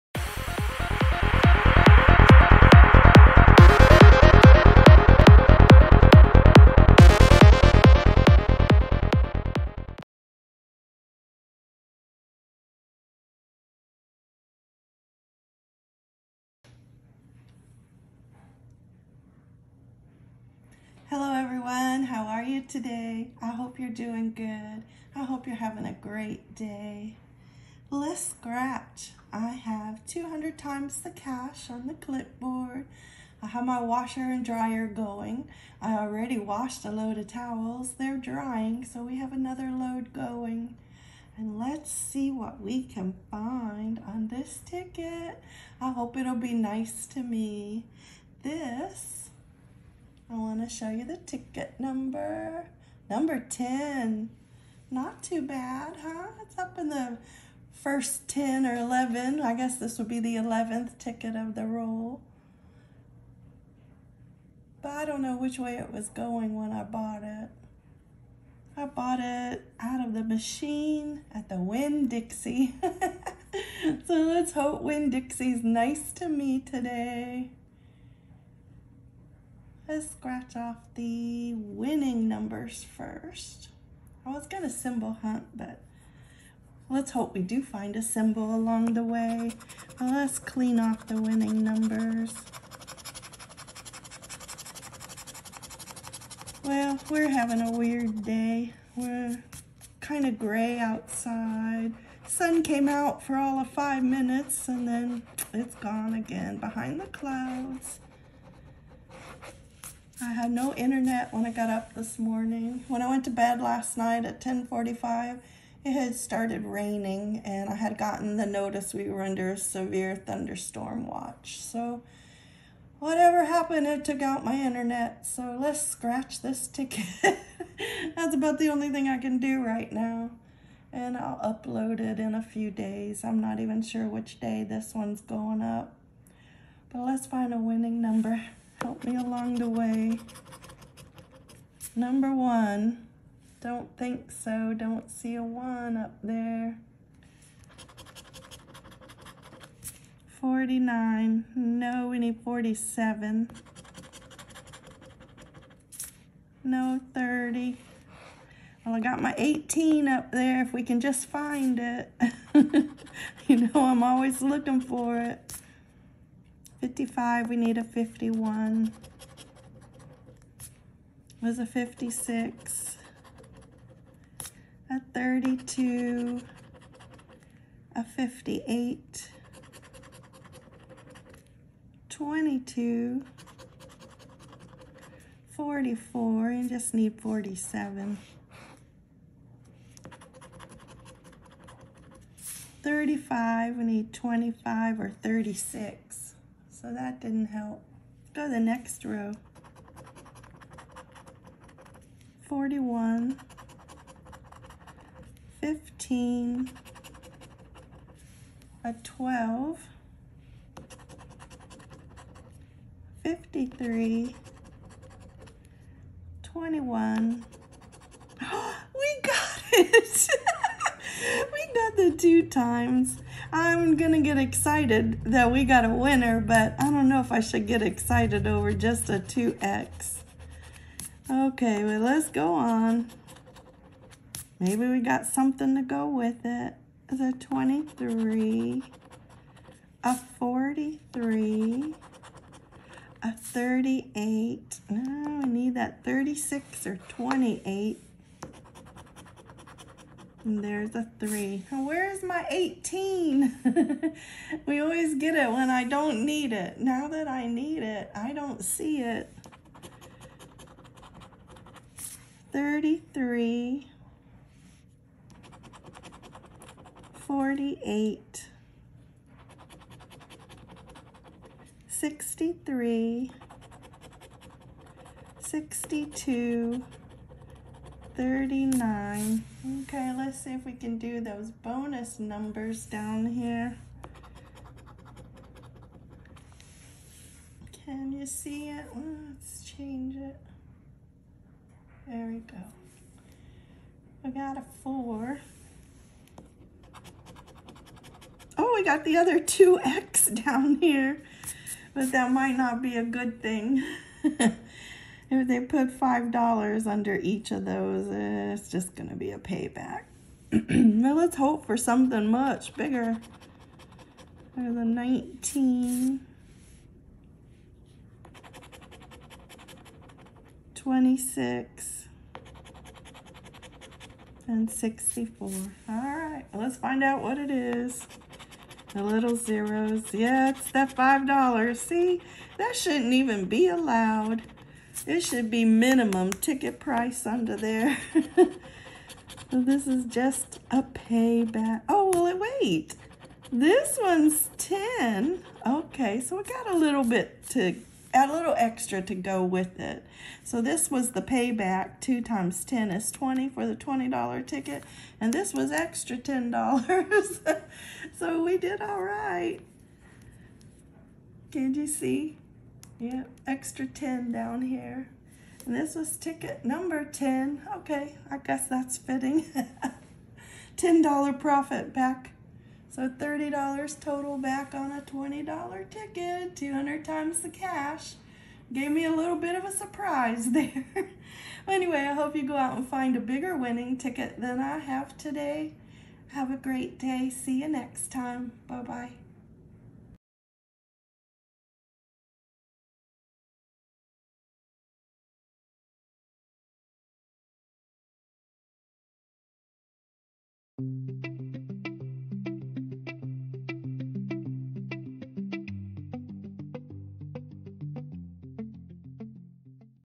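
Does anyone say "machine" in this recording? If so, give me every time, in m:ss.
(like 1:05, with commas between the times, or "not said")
1:10.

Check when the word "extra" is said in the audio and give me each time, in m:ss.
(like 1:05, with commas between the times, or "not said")
5:48, 5:55, 6:03.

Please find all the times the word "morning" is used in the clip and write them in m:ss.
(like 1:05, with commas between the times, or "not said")
1:52.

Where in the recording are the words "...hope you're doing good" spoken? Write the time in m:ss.
0:23.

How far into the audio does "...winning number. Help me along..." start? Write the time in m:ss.
2:17.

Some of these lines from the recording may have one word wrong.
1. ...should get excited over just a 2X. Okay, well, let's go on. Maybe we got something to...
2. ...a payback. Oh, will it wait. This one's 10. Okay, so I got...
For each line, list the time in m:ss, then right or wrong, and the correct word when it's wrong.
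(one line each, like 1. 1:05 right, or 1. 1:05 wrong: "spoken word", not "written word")
1. 3:47 right
2. 5:40 right.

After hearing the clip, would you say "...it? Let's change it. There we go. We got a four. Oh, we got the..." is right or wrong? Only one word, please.
right.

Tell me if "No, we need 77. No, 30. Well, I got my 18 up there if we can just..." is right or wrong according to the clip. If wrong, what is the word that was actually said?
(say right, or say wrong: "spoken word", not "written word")
wrong: "47", not "77".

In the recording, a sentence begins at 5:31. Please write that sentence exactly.
See, that shouldn't even be allowed.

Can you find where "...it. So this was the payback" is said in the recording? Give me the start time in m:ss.
5:49.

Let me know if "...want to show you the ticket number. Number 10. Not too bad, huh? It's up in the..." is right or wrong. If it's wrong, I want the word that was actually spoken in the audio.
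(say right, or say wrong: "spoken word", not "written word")
right.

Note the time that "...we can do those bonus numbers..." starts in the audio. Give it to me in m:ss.
4:40.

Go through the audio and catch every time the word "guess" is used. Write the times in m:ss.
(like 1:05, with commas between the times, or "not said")
0:59, 6:08.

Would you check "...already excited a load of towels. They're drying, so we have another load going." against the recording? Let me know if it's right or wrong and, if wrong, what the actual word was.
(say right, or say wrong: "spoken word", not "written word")
wrong: "washed", not "excited".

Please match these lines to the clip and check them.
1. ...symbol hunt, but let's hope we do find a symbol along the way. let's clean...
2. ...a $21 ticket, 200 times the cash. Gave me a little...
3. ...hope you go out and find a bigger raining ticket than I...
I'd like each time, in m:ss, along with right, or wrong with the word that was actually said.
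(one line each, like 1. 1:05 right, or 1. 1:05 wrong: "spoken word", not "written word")
1. 1:24 right
2. 6:14 wrong: "20", not "21"
3. 6:22 wrong: "winning", not "raining".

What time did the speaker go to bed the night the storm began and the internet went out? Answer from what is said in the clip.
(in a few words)
10:45.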